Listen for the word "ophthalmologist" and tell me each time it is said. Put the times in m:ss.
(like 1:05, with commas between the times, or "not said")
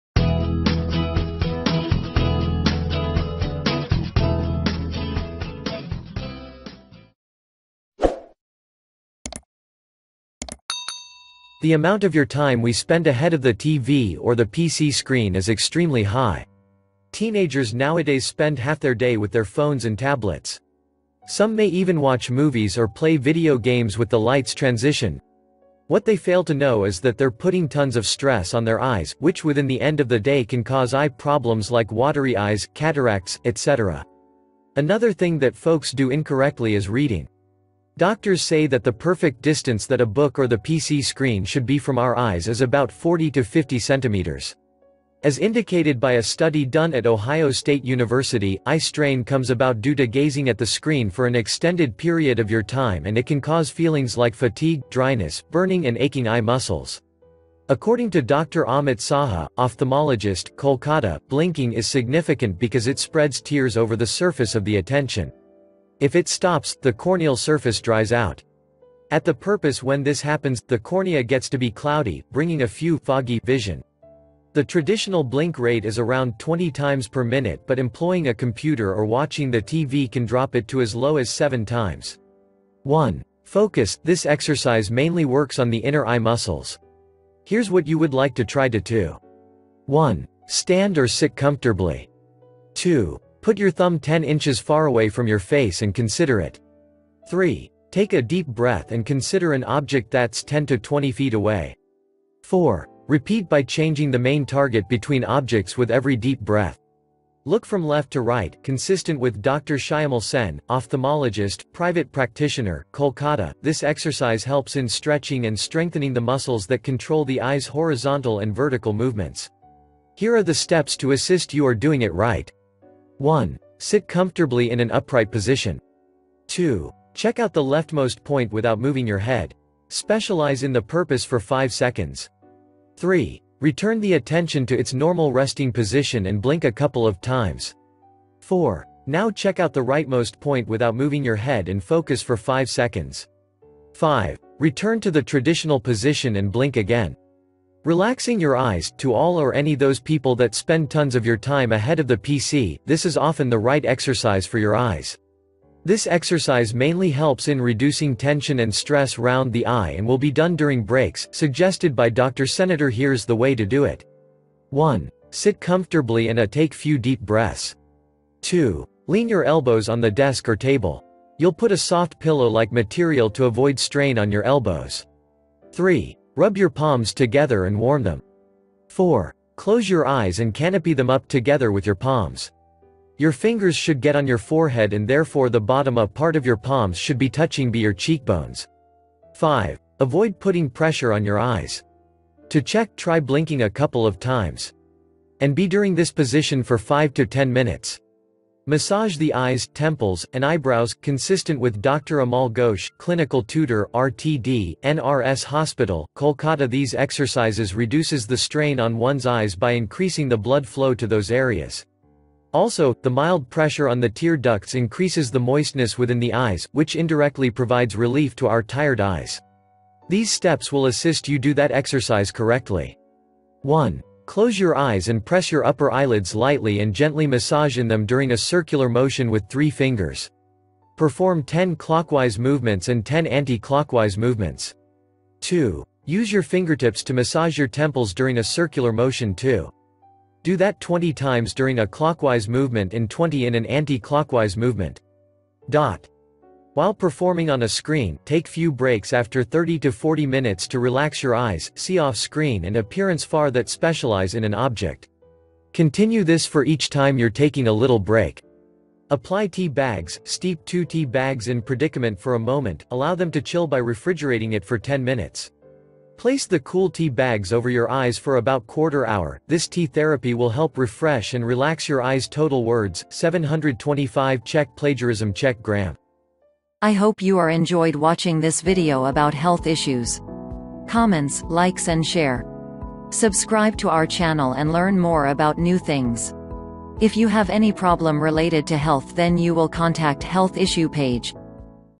0:59, 1:50.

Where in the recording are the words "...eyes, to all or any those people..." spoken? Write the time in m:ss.
2:28.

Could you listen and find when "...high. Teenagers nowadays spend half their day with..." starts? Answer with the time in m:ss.
0:16.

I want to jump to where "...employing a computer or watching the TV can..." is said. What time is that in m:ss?
1:17.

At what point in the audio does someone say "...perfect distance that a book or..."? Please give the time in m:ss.
0:38.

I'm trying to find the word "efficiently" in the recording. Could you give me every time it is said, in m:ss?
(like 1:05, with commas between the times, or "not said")
not said.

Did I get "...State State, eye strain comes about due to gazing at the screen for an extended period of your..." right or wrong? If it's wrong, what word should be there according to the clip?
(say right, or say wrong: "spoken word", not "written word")
wrong: "University", not "State".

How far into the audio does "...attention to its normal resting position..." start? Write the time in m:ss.
2:14.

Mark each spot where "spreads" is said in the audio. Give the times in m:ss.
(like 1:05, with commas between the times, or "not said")
1:02.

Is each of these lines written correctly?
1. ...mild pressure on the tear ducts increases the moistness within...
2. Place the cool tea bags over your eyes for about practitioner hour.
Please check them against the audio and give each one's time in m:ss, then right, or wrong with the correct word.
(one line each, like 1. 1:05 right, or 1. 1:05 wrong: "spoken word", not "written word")
1. 3:33 right
2. 4:26 wrong: "quarter", not "practitioner".